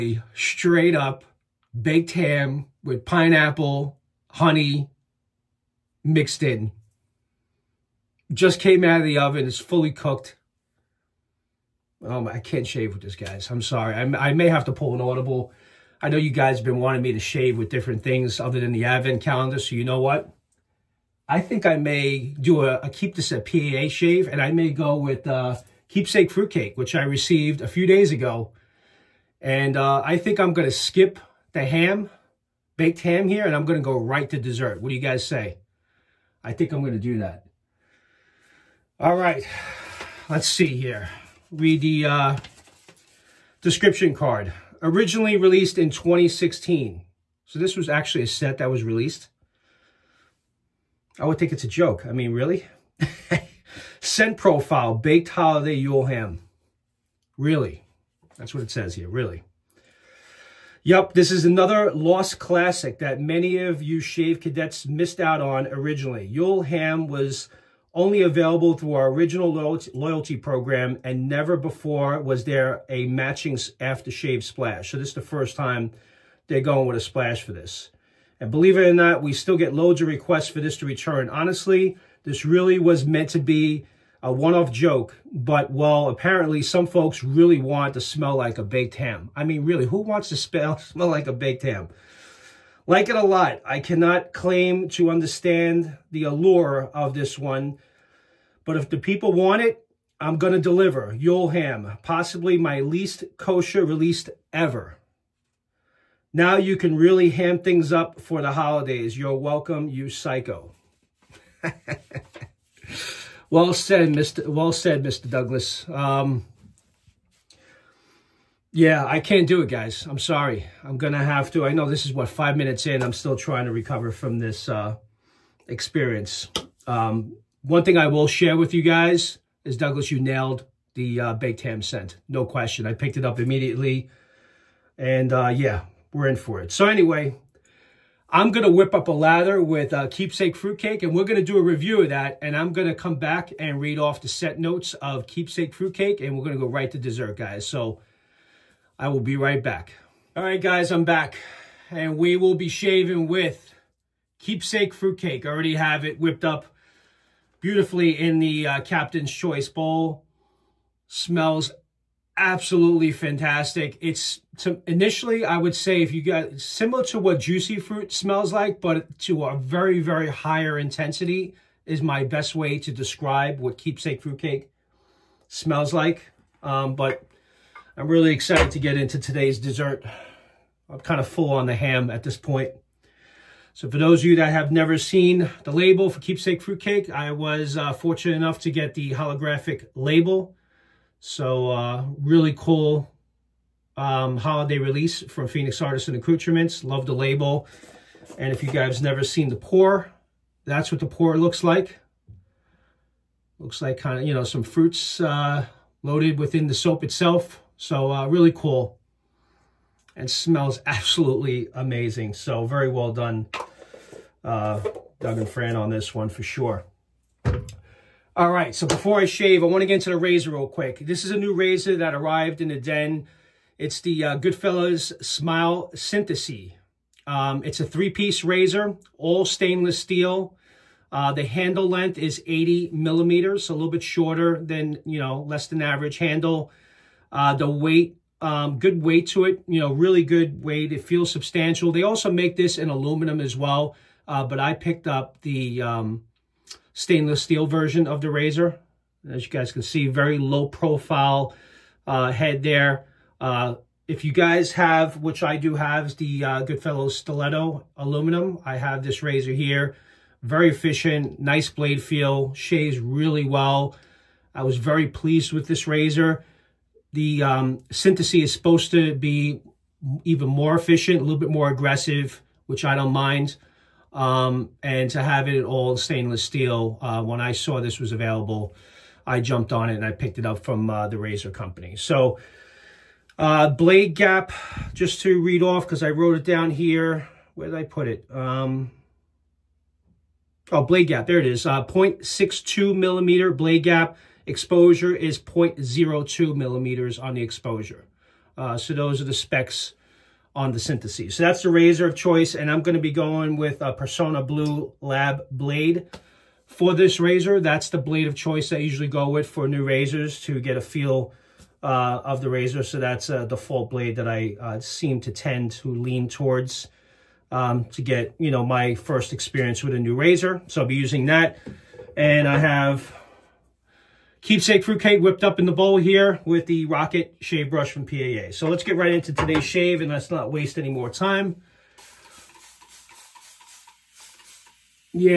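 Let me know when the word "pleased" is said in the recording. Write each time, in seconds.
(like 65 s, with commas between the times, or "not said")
265 s.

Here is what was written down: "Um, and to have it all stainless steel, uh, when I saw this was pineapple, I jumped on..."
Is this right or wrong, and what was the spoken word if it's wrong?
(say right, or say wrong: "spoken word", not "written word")
wrong: "available", not "pineapple".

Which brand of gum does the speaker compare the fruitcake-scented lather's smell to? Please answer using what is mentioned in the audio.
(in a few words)
Juicy Fruit.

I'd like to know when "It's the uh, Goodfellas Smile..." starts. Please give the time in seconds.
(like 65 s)
223 s.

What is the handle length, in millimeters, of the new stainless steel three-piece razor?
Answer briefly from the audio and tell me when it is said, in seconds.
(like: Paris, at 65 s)
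80, at 232 s.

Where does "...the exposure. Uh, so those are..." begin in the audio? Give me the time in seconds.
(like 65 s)
297 s.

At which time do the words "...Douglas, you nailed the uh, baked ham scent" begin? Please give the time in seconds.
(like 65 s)
129 s.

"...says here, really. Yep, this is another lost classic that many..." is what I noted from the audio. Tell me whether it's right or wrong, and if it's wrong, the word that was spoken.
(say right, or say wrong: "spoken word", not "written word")
right.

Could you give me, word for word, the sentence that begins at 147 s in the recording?
So I will be right back.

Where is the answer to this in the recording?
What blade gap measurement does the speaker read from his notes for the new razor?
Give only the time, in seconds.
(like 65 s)
291 s.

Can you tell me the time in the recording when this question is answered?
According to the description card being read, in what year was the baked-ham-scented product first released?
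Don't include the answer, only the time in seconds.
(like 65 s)
45 s.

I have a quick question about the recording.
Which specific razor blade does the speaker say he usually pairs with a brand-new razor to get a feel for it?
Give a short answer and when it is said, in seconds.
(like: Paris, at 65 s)
Personna Blue Lab, at 303 s.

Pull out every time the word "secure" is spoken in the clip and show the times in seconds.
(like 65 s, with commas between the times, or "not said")
not said.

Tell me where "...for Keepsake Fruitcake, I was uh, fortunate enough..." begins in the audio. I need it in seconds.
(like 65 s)
186 s.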